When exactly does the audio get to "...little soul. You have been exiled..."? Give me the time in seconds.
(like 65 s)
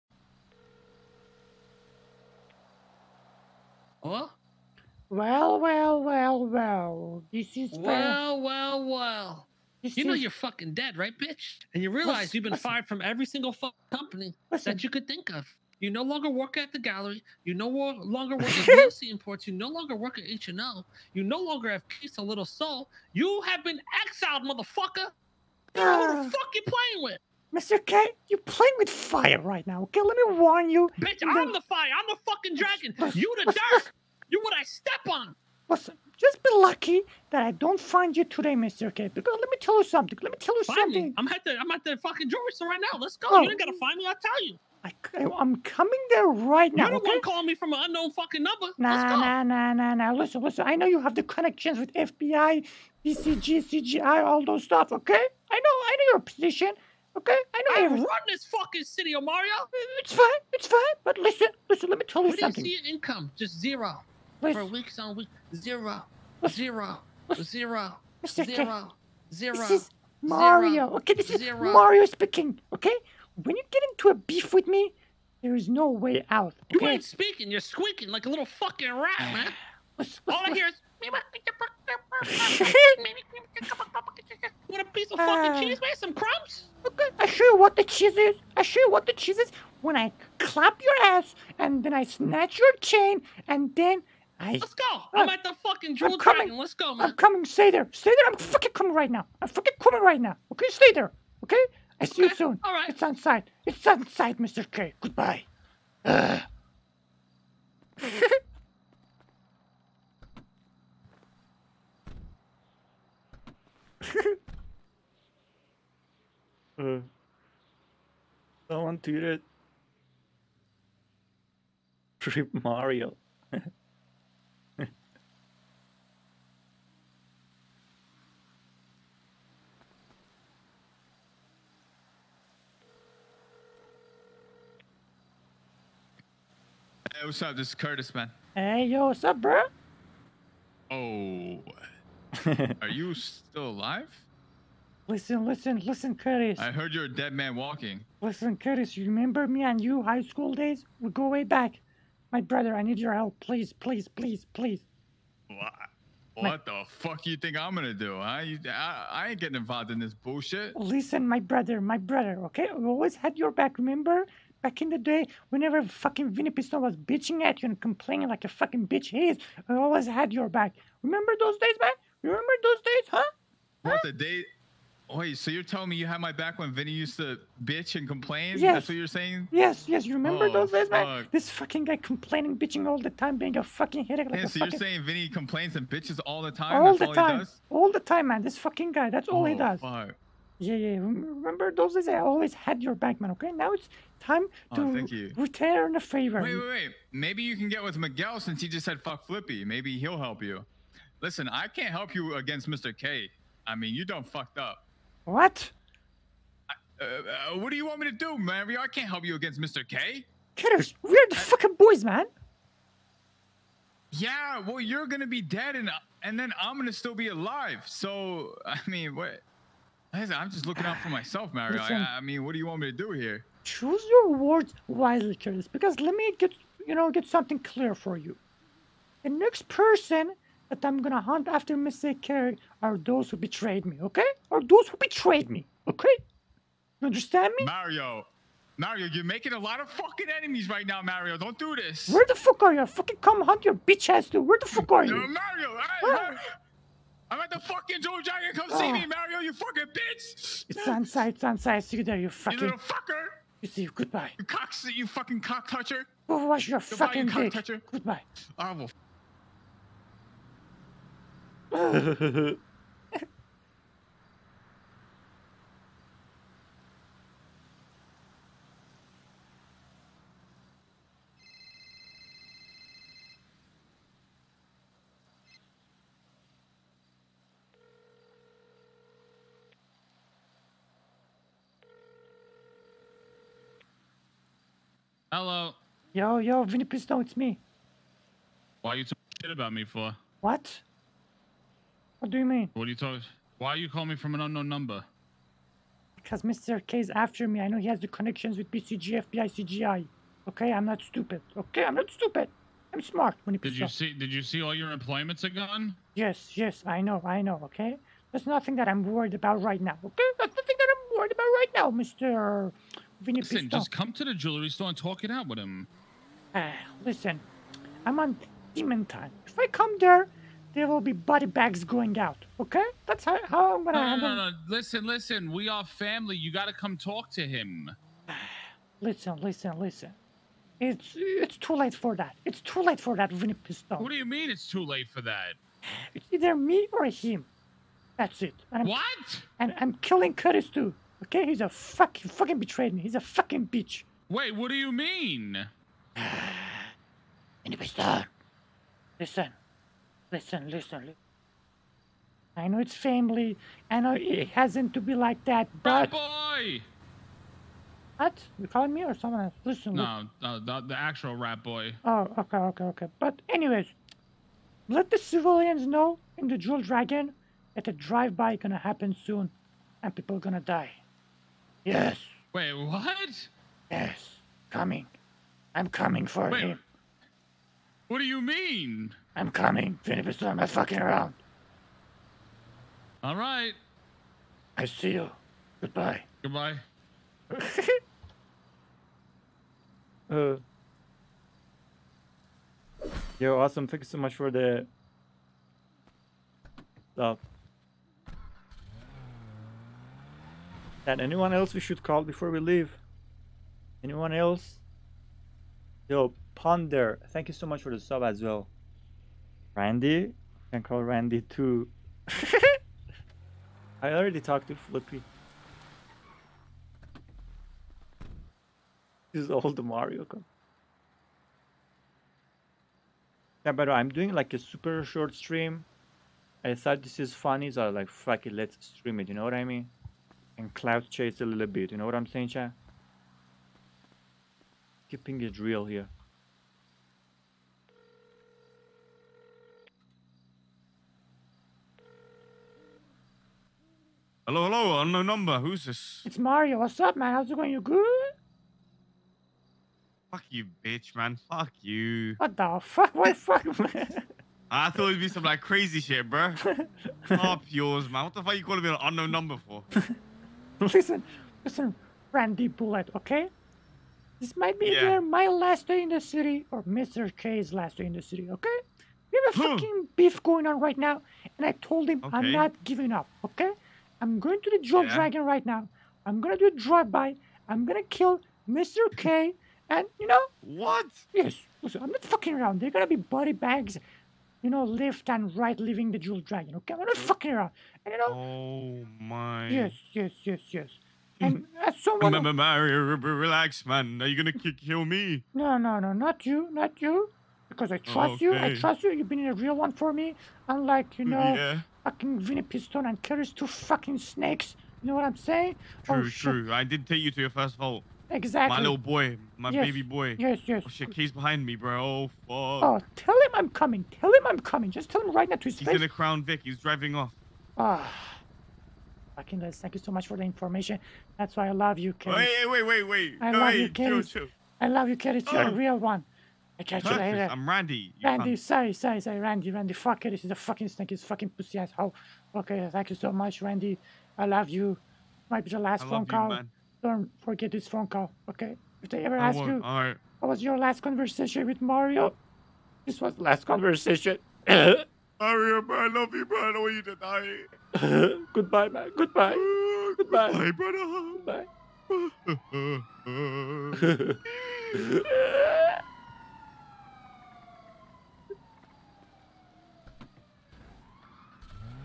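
22 s.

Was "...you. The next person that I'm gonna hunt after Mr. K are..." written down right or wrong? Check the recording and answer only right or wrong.
right.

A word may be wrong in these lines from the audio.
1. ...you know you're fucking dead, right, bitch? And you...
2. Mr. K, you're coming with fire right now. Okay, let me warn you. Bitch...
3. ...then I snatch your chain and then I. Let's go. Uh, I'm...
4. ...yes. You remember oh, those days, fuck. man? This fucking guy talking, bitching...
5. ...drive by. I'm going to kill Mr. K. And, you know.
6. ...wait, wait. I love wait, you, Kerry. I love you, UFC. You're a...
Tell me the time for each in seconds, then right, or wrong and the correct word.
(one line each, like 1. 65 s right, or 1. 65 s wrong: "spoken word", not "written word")
1. 9 s right
2. 27 s wrong: "playing", not "coming"
3. 91 s right
4. 179 s wrong: "complaining", not "talking"
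5. 476 s right
6. 522 s wrong: "Kerry", not "UFC".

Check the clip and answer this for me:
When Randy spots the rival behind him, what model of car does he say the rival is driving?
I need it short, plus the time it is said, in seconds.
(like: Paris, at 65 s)
Crown Vic, at 516 s.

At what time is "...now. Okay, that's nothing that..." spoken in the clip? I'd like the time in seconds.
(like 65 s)
309 s.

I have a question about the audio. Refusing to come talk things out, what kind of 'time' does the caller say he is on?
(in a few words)
demon time.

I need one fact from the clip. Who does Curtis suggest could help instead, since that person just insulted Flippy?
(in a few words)
Miguel.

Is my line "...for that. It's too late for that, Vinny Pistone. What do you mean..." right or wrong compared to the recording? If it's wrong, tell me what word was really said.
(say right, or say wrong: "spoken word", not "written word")
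right.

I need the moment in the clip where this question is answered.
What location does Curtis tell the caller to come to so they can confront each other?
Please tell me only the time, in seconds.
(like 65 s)
248 s.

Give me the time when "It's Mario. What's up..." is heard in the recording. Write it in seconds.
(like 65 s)
446 s.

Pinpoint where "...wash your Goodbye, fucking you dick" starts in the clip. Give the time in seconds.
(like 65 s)
256 s.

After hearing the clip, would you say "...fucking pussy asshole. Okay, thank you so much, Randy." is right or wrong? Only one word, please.
right.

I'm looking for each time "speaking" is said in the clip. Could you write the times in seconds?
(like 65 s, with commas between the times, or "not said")
72 s, 77 s.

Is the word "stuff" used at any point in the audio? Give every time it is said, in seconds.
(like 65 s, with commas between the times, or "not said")
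54 s, 397 s.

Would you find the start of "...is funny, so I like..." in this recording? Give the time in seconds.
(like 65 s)
427 s.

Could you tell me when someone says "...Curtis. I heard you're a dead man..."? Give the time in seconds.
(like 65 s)
146 s.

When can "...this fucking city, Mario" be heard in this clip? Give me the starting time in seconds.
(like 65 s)
58 s.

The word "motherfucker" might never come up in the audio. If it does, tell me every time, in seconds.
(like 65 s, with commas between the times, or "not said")
24 s.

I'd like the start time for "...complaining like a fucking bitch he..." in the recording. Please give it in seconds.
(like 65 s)
167 s.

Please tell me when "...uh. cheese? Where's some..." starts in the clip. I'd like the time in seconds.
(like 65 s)
85 s.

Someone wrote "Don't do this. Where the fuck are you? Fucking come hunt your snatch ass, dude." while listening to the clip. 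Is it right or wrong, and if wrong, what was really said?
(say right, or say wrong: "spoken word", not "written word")
wrong: "bitch", not "snatch".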